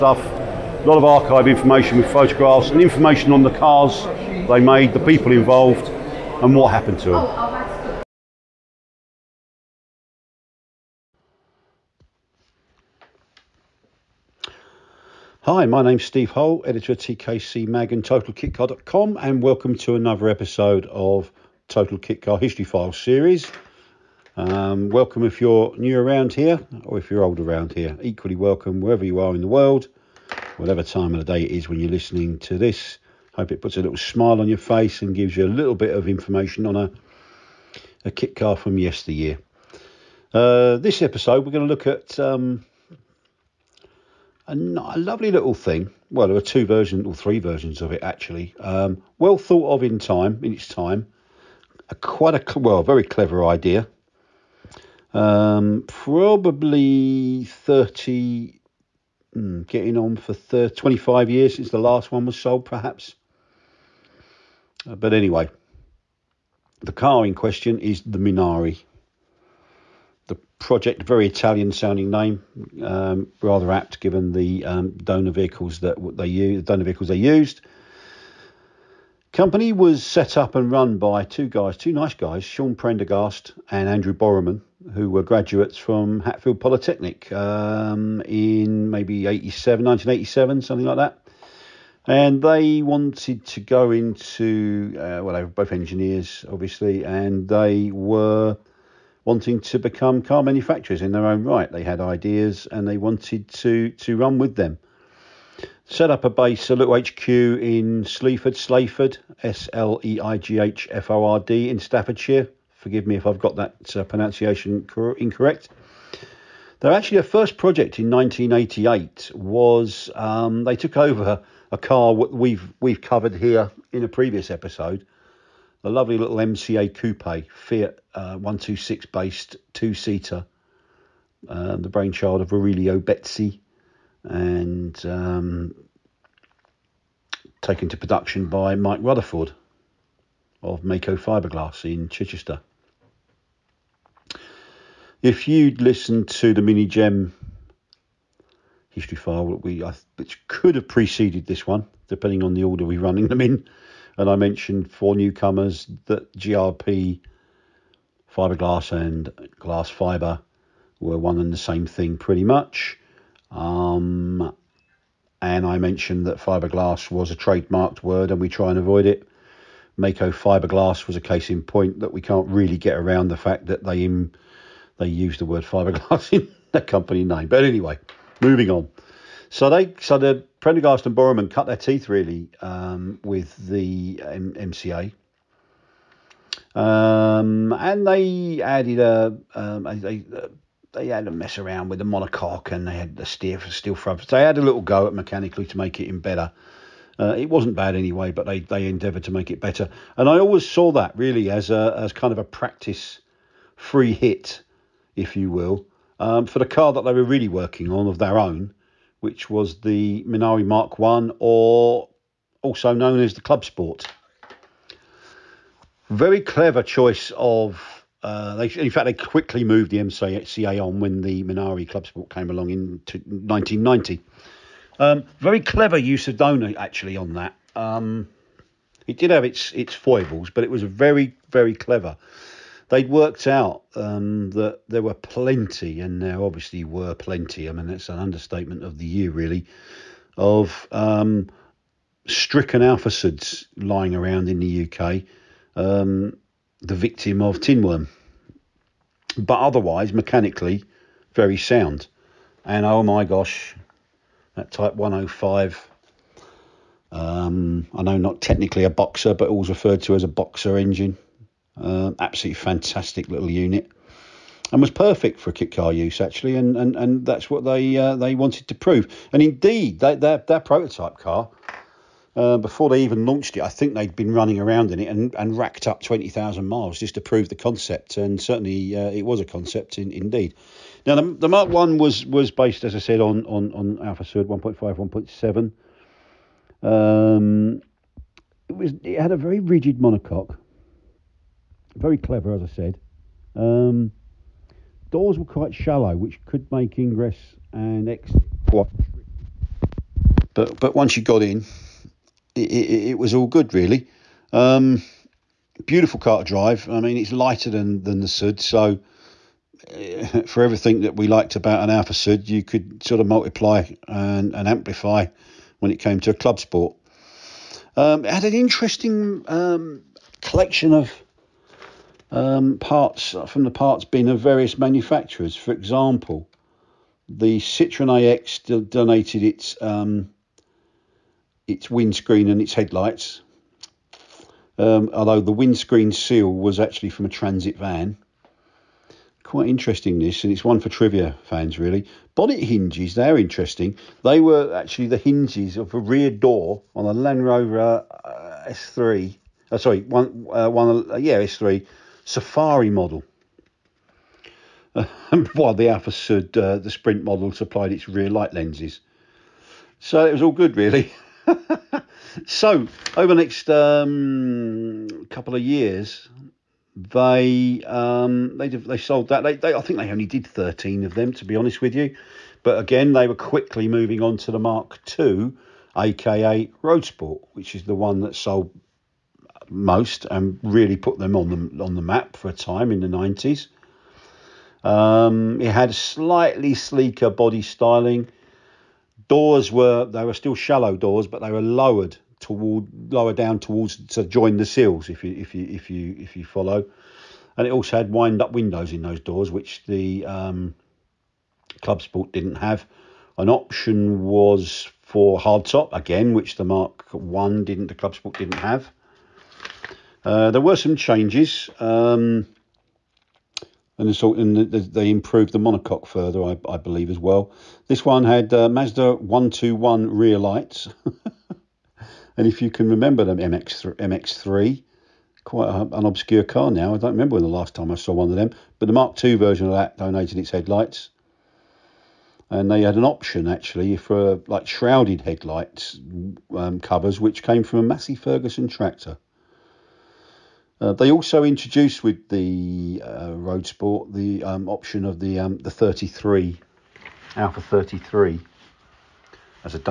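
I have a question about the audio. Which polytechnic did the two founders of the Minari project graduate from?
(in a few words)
Hatfield Polytechnic.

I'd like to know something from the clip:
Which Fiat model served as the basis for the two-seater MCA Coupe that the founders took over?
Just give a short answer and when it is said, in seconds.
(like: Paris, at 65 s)
Fiat 126, at 127 s.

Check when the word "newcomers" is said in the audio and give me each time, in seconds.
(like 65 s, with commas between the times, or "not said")
155 s.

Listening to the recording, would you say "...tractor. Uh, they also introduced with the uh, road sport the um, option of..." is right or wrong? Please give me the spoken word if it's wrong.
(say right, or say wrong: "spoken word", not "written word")
right.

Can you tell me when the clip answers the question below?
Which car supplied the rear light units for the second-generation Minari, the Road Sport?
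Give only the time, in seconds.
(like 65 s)
418 s.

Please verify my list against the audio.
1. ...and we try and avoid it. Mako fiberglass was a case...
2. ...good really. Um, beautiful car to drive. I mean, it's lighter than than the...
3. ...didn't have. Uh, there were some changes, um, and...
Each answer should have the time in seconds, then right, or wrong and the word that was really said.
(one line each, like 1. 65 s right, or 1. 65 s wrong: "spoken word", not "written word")
1. 168 s right
2. 303 s right
3. 408 s right.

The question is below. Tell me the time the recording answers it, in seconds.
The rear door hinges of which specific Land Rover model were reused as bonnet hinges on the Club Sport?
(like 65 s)
351 s.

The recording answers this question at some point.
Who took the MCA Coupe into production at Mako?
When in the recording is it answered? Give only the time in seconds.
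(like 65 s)
138 s.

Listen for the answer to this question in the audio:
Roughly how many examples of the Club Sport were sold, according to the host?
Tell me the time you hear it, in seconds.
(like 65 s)
370 s.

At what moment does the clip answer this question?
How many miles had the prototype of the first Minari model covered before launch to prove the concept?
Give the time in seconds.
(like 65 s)
276 s.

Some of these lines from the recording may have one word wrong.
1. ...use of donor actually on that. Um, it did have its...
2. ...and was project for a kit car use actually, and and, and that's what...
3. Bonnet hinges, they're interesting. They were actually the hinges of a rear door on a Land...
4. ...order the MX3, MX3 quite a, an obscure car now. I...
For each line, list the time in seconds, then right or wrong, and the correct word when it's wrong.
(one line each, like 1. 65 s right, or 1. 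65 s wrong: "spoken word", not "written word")
1. 225 s right
2. 264 s wrong: "perfect", not "project"
3. 342 s right
4. 422 s wrong: "remember", not "order".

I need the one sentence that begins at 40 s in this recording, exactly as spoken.
Uh, this episode, we're going to look at um, a, a lovely little thing.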